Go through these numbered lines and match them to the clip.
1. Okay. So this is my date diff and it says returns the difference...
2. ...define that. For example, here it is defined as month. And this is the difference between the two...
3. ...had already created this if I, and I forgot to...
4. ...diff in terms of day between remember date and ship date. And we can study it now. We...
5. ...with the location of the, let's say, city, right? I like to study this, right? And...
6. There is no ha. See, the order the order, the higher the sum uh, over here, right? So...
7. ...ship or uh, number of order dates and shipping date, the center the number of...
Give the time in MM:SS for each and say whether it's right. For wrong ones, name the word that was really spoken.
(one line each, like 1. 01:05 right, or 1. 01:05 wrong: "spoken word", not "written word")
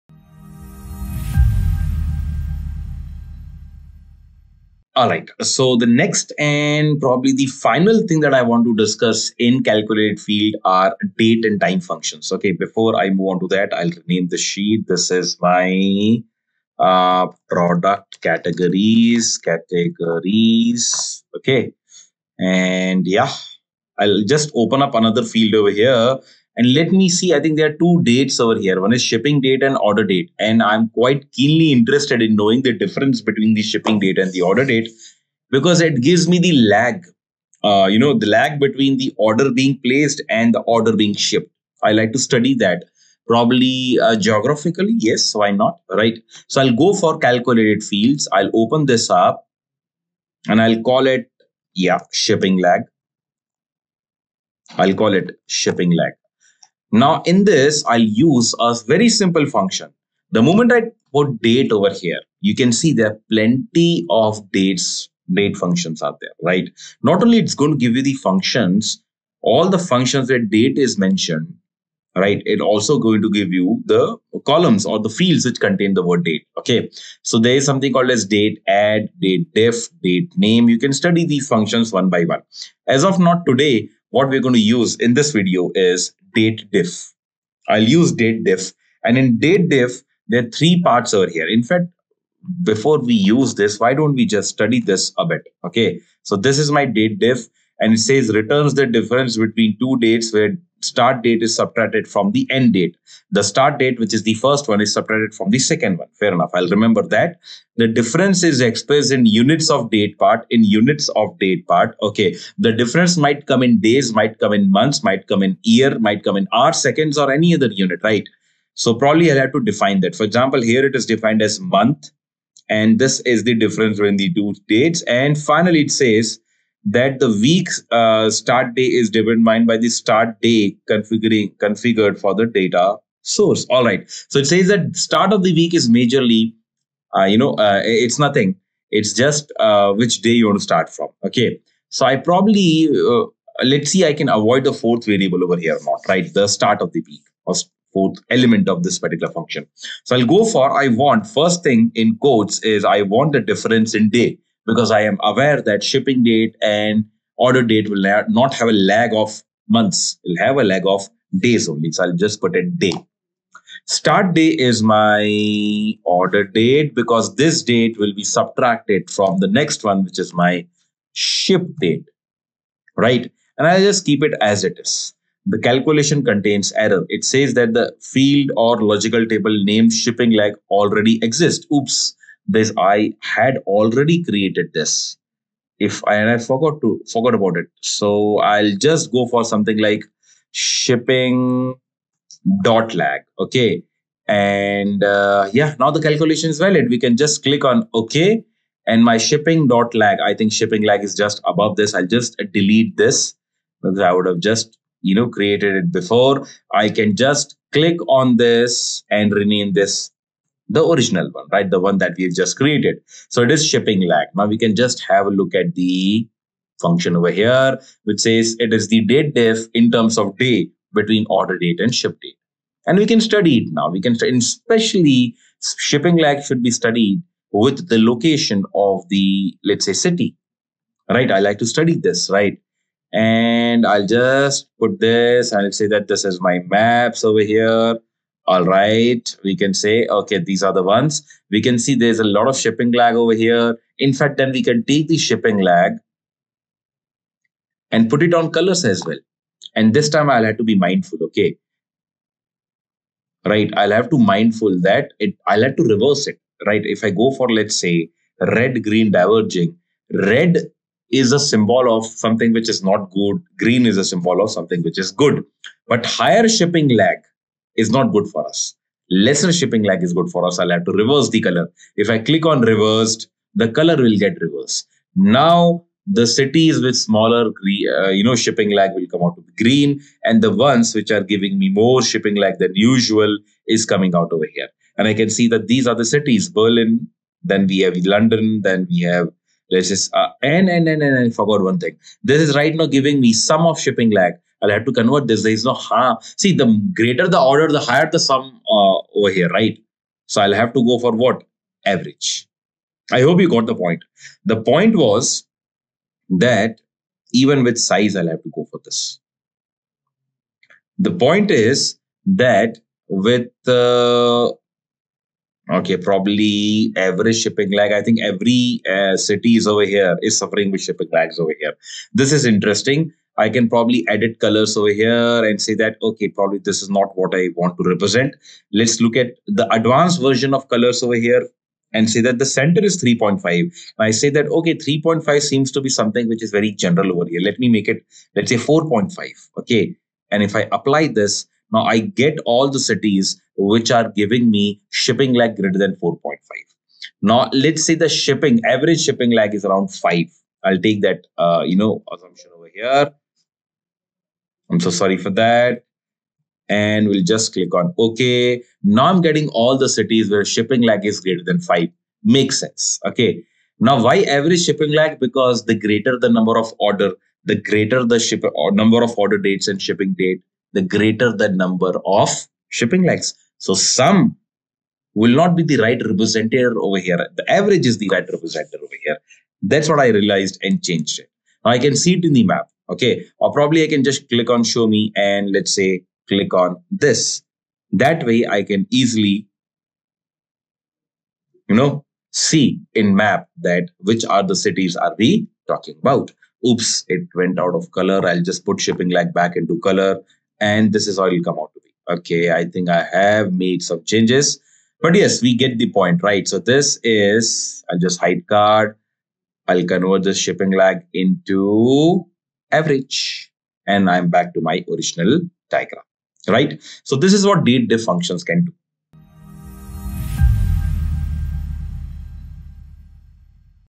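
1. 01:35 right
2. 01:59 right
3. 03:03 right
4. 03:39 wrong: "order", not "remember"
5. 03:47 right
6. 04:55 wrong: "greater", not "order"
7. 06:08 wrong: "greater", not "center".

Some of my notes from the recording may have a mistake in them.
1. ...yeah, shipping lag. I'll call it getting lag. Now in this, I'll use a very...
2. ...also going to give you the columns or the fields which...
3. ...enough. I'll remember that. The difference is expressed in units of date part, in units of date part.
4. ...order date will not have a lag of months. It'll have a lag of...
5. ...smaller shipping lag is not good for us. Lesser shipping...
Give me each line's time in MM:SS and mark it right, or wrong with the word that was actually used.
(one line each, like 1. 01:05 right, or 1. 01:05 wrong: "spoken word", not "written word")
1. 00:51 wrong: "shipping", not "getting"
2. 01:12 right
3. 01:46 right
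4. 02:37 right
5. 04:26 wrong: "higher", not "smaller".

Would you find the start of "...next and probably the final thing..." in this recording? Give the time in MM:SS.
00:05.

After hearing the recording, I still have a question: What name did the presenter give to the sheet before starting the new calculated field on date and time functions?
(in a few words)
product categories.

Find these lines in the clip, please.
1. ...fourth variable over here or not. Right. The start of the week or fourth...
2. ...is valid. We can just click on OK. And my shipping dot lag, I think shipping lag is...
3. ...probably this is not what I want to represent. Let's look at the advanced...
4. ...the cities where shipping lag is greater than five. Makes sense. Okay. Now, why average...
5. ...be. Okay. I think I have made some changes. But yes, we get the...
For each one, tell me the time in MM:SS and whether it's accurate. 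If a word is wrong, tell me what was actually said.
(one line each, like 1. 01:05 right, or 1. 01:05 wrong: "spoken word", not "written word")
1. 02:24 right
2. 03:16 right
3. 05:26 right
4. 05:59 right
5. 06:41 right.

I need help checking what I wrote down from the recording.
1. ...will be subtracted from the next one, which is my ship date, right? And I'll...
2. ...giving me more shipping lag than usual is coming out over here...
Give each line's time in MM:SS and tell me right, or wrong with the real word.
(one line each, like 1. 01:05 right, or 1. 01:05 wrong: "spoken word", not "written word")
1. 02:47 right
2. 04:41 right.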